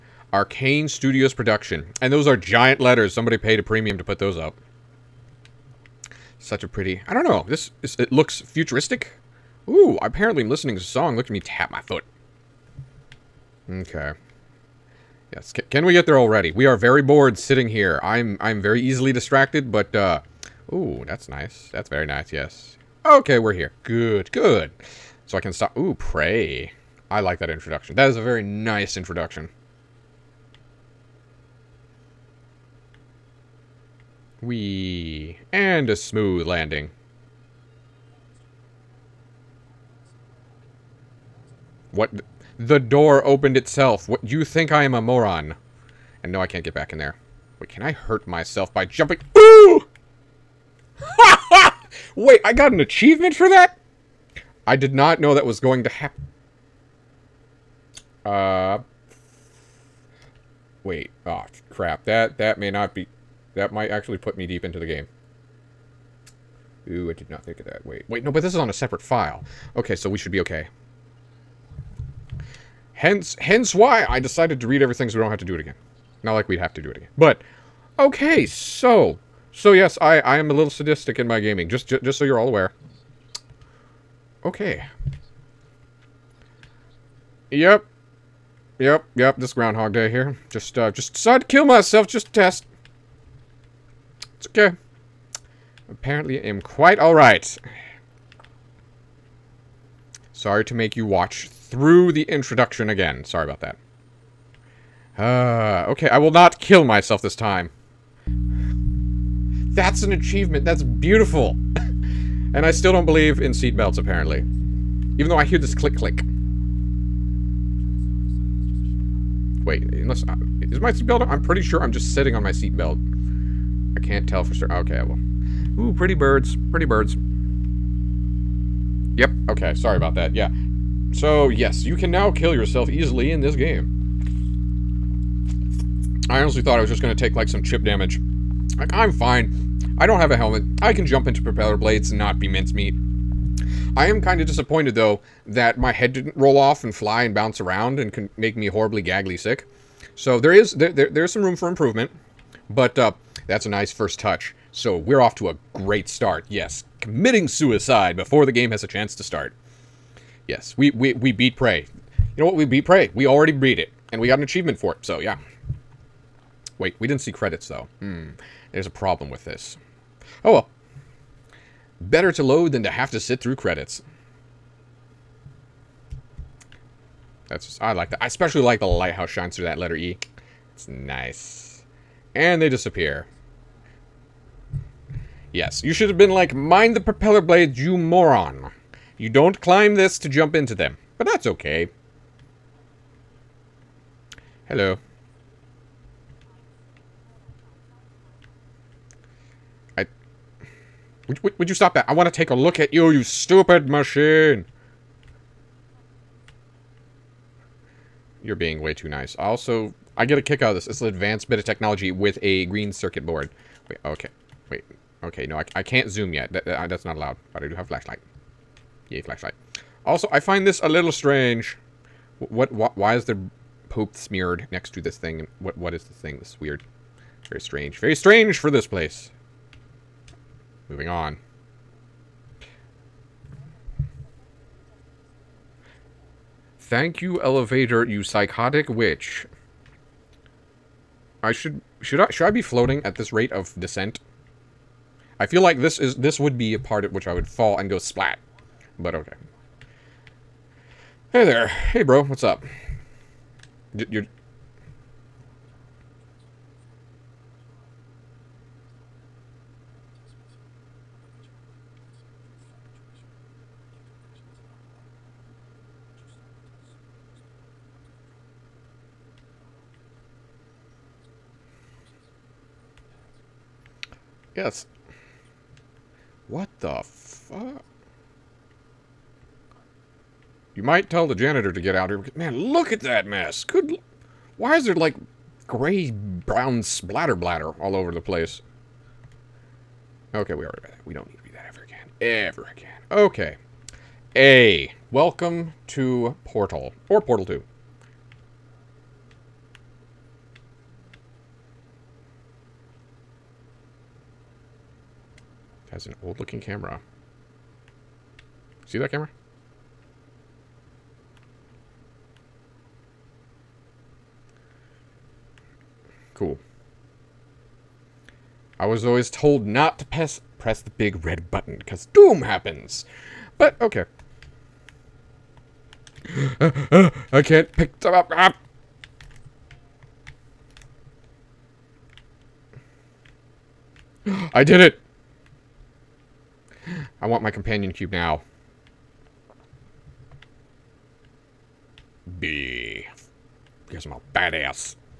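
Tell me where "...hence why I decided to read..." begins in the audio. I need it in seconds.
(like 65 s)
73 s.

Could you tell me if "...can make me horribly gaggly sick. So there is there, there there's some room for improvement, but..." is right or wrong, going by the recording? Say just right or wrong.
right.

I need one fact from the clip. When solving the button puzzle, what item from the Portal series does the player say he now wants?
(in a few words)
companion cube.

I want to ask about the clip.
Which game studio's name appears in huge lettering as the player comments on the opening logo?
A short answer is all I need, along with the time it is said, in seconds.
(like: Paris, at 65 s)
Arkane Studios, at 0 s.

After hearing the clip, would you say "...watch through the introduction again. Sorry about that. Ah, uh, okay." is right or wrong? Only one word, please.
right.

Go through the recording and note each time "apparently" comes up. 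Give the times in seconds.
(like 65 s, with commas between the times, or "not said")
10 s, 95 s, 113 s.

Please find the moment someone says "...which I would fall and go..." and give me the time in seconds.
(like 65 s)
247 s.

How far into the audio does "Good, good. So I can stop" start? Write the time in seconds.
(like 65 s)
23 s.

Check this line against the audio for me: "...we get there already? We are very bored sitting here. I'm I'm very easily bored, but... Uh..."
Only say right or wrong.
wrong.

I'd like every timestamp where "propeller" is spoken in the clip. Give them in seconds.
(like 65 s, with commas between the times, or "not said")
141 s, 186 s.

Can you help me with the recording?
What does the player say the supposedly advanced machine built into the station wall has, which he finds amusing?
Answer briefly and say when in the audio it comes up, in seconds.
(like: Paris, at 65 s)
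green circuit board, at 212 s.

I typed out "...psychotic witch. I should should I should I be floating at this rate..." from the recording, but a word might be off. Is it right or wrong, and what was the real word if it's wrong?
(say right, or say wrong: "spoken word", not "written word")
right.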